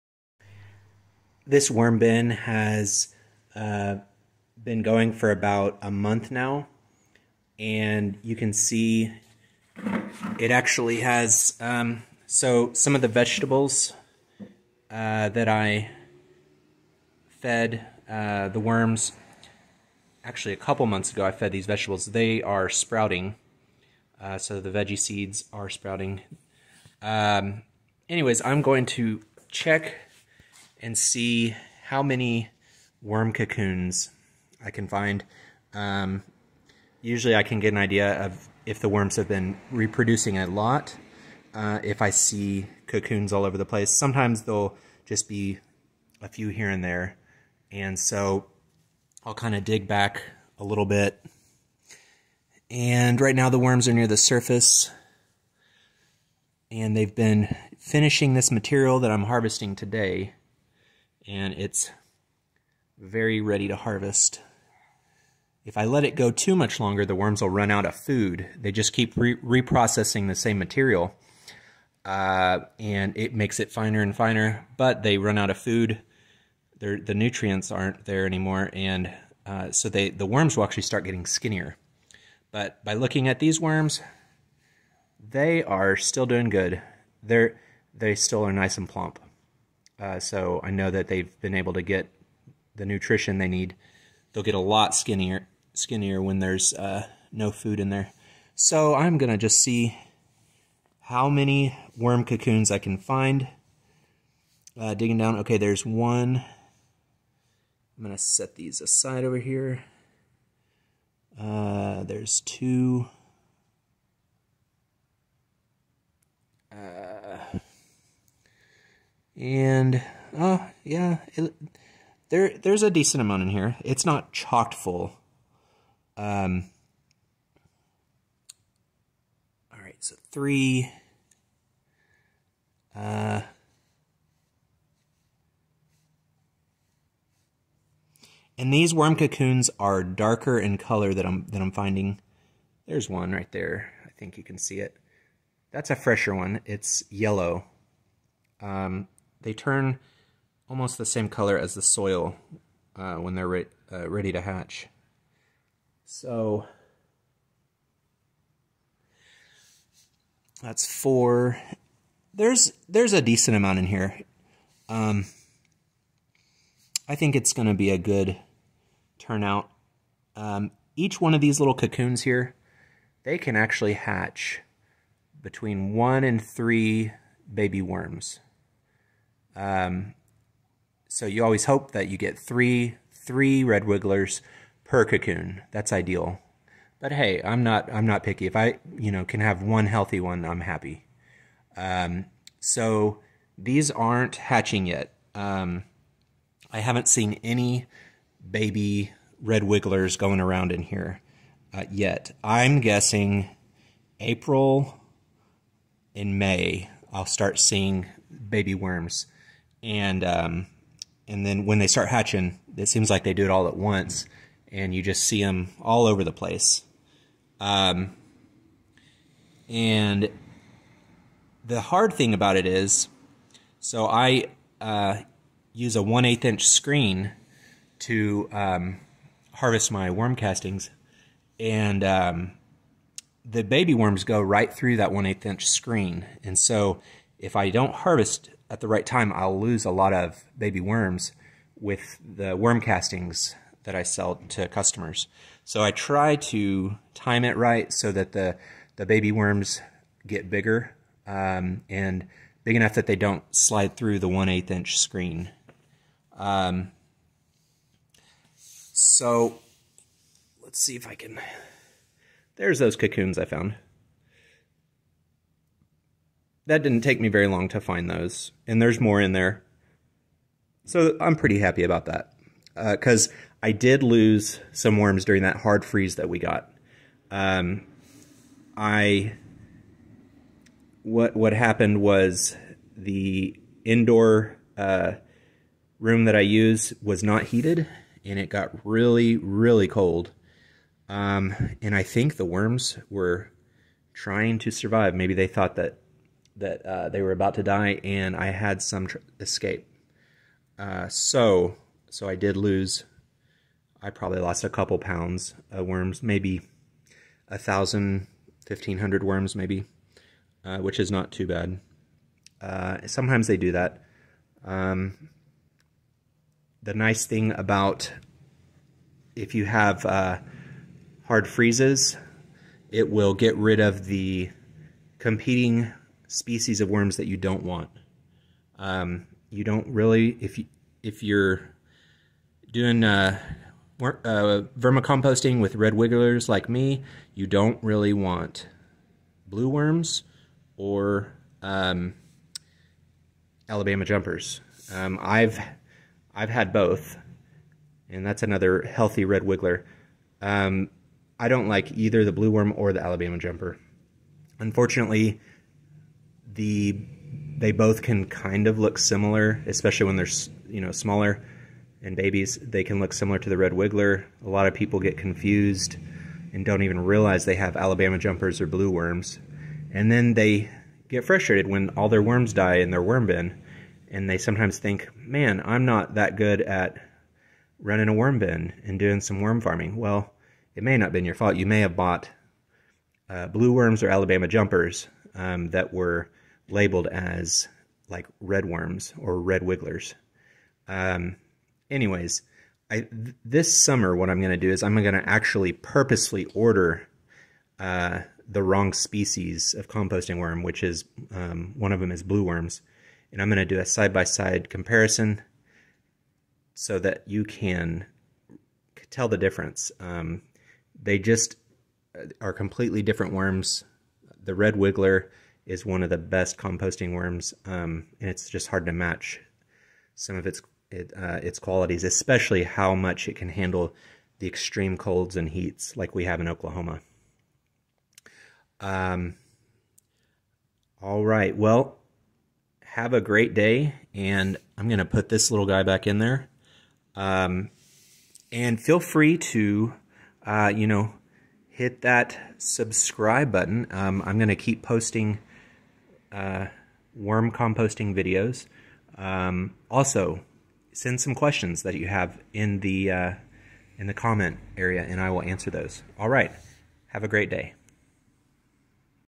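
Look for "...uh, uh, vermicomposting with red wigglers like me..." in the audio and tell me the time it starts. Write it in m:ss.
5:33.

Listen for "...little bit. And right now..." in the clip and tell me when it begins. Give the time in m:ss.
0:50.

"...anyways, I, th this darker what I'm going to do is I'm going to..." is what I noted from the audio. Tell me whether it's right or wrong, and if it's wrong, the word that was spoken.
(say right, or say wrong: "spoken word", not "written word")
wrong: "summer", not "darker".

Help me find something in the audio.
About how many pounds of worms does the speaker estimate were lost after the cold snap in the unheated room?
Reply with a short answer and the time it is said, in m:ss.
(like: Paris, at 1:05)
a couple pounds, at 5:04.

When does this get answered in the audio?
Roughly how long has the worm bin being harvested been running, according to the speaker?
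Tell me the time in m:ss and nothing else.
0:05.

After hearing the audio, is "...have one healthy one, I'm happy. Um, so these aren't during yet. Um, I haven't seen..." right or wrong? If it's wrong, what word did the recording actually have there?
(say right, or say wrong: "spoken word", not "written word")
wrong: "hatching", not "during".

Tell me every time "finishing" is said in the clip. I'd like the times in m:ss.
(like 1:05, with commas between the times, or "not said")
0:57.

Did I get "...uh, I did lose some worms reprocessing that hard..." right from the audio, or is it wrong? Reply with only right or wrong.
wrong.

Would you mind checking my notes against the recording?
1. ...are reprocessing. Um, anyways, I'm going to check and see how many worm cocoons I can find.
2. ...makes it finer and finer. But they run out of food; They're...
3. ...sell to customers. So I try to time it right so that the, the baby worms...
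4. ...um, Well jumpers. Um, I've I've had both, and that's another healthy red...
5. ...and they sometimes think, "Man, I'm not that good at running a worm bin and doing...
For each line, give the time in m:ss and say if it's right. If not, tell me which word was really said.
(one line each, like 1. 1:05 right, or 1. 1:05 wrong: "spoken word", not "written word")
1. 0:25 wrong: "sprouting", not "reprocessing"
2. 1:13 right
3. 4:04 right
4. 5:41 wrong: "Alabama", not "Well"
5. 6:14 right.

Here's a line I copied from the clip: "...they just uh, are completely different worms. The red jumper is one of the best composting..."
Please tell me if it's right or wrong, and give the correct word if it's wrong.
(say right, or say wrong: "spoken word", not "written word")
wrong: "wiggler", not "jumper".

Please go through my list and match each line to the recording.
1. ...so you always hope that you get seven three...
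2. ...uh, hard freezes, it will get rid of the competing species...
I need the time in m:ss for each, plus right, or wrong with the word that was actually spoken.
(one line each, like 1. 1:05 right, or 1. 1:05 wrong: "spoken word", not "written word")
1. 3:01 wrong: "three", not "seven"
2. 5:20 right.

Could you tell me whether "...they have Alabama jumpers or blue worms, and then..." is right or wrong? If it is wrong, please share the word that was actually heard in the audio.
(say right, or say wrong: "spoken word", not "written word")
right.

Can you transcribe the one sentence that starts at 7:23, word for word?
Um, I'm going to keep posting uh, worm composting videos.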